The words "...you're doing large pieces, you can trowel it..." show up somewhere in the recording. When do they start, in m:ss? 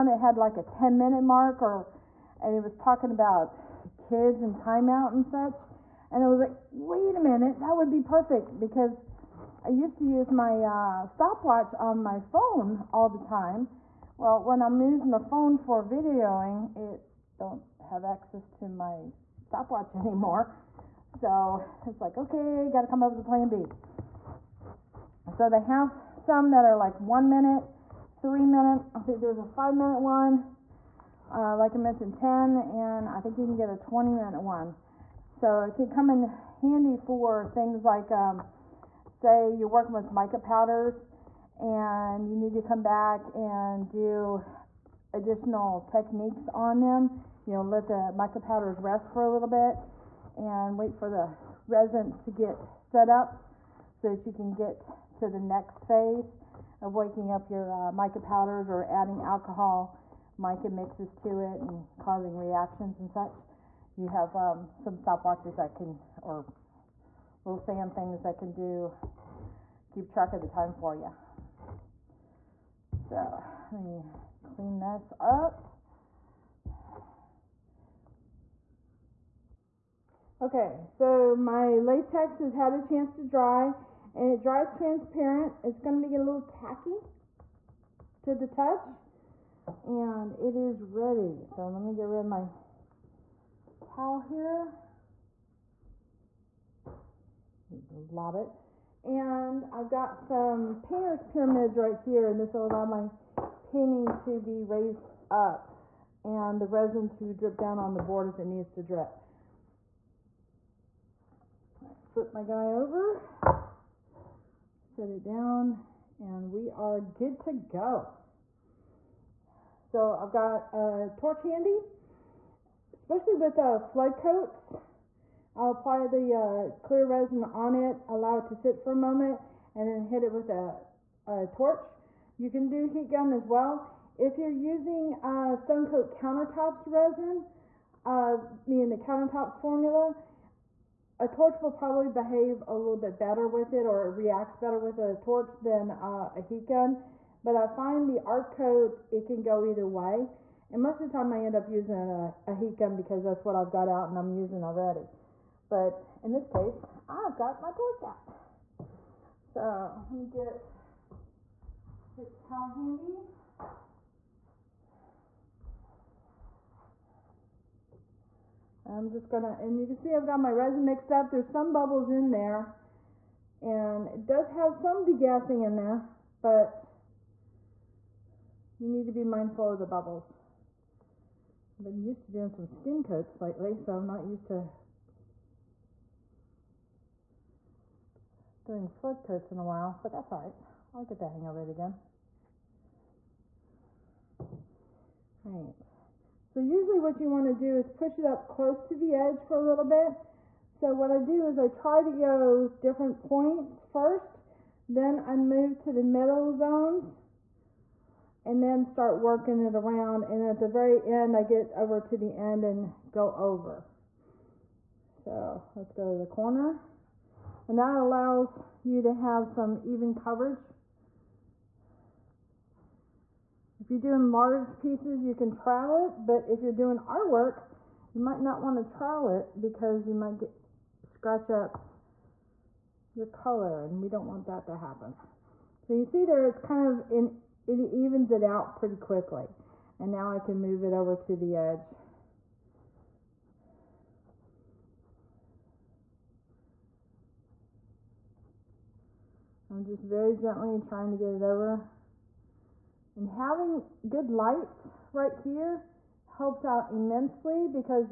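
3:43.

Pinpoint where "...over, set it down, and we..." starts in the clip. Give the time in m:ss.
1:52.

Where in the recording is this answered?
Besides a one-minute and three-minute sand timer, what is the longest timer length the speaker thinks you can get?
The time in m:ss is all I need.
0:33.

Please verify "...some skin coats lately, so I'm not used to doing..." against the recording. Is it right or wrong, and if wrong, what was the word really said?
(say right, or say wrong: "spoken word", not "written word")
right.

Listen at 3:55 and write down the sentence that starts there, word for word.
So you see there, it's kind of, in, it evens it out pretty quickly.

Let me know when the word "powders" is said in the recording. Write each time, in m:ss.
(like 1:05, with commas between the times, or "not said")
0:40, 0:48, 0:58.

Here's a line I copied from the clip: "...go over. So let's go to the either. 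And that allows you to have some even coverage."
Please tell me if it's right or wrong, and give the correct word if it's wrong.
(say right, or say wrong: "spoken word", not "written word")
wrong: "corner", not "either".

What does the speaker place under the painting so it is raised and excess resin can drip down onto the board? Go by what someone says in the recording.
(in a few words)
painter's pyramids.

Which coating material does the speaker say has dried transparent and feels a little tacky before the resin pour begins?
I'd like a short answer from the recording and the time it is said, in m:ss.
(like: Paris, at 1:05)
latex, at 1:21.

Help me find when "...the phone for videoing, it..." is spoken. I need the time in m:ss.
0:15.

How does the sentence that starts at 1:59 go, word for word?
So I've got a torch handy, especially with uh, flood coats.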